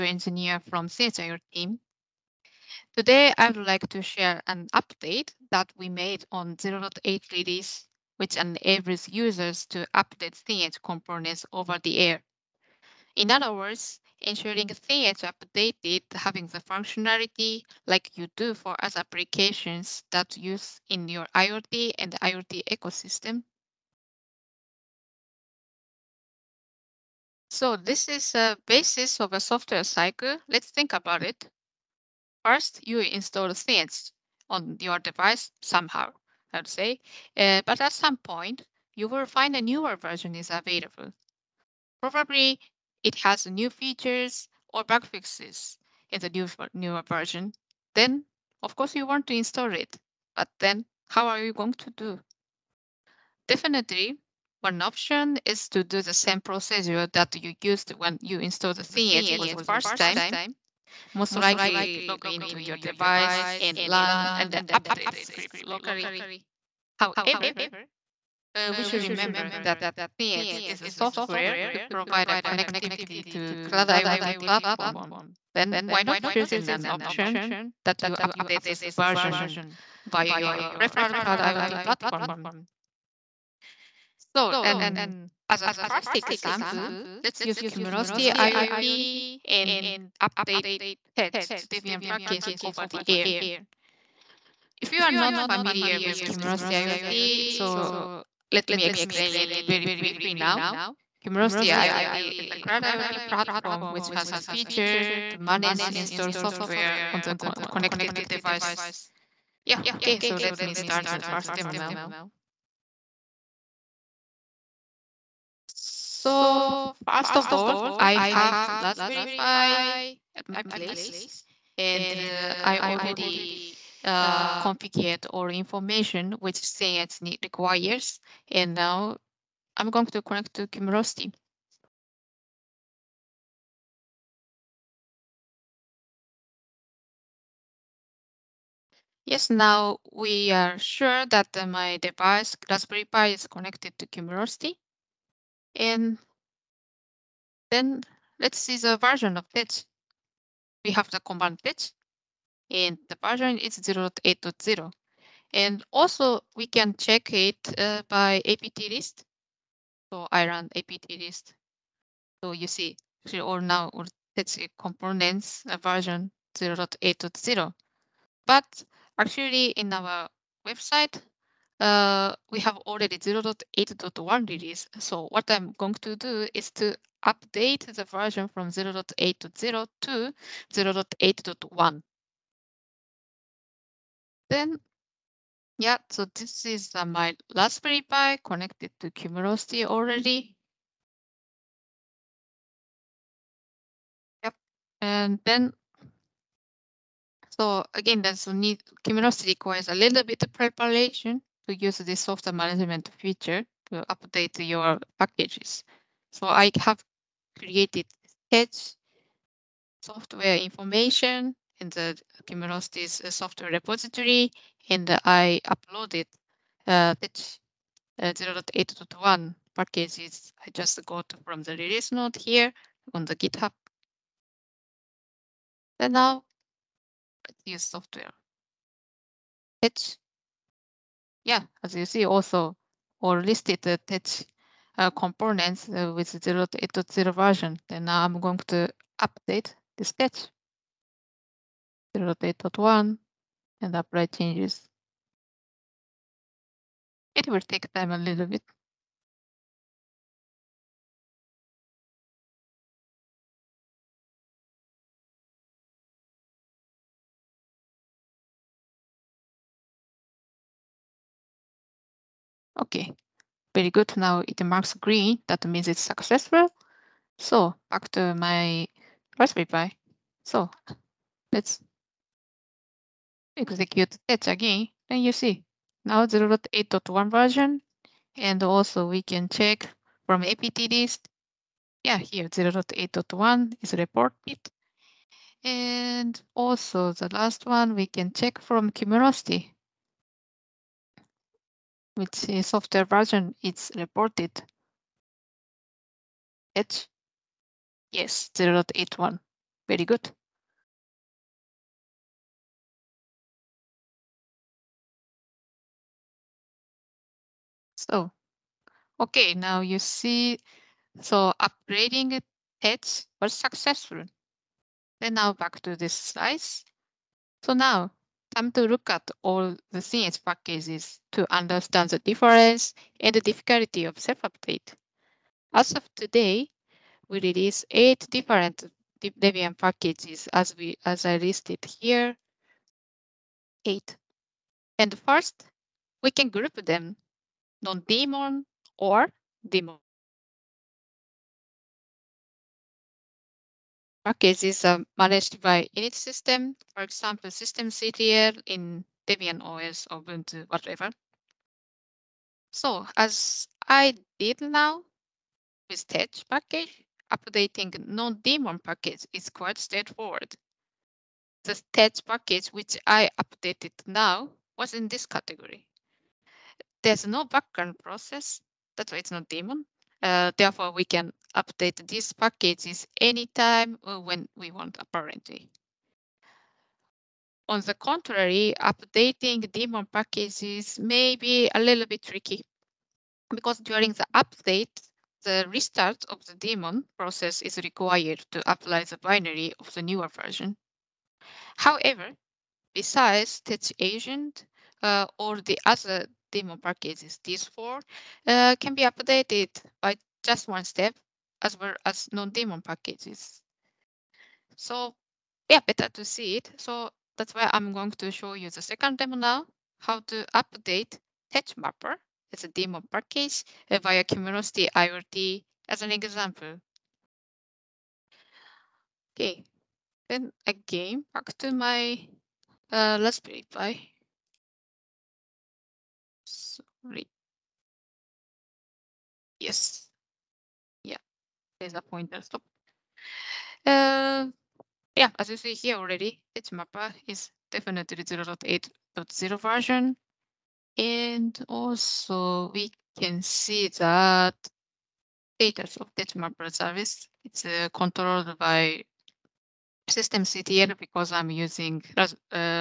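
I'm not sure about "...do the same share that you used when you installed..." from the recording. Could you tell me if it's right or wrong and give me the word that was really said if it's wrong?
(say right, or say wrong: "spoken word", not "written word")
wrong: "procedure", not "share".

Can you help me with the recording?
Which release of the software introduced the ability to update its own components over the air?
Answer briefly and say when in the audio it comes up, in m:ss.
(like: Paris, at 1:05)
0.8, at 0:06.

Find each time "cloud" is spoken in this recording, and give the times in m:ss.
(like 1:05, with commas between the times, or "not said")
1:13, 1:21, 1:42.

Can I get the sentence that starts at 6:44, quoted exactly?
So yeah, better to see it.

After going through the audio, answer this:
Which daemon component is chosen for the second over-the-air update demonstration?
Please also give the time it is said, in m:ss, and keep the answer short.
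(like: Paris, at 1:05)
tedge Mapper, at 6:51.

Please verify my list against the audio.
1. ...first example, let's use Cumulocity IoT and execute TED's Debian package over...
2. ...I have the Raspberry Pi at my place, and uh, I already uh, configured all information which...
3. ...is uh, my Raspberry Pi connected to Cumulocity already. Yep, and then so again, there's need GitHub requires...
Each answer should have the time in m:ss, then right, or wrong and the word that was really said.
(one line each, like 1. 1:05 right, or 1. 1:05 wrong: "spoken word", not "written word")
1. 1:25 wrong: "update", not "execute"
2. 1:57 right
3. 3:06 wrong: "Cumulocity", not "GitHub".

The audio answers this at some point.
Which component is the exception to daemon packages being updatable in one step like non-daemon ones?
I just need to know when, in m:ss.
6:33.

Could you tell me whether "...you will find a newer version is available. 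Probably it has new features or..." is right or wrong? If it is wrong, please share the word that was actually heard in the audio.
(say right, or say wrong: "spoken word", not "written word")
right.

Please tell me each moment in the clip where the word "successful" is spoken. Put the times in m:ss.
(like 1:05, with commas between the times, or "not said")
4:26, 5:13.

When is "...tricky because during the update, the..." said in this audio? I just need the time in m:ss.
6:22.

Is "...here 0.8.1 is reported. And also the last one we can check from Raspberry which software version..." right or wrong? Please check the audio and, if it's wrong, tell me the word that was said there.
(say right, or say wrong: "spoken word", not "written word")
wrong: "Cumulocity", not "Raspberry".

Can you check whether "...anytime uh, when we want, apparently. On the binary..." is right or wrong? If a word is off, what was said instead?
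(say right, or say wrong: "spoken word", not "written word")
wrong: "contrary", not "binary".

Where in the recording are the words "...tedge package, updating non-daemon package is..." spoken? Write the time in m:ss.
5:56.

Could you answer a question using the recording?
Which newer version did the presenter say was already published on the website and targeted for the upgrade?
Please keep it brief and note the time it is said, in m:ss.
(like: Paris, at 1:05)
0.8.1, at 2:53.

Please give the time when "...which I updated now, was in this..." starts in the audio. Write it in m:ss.
6:02.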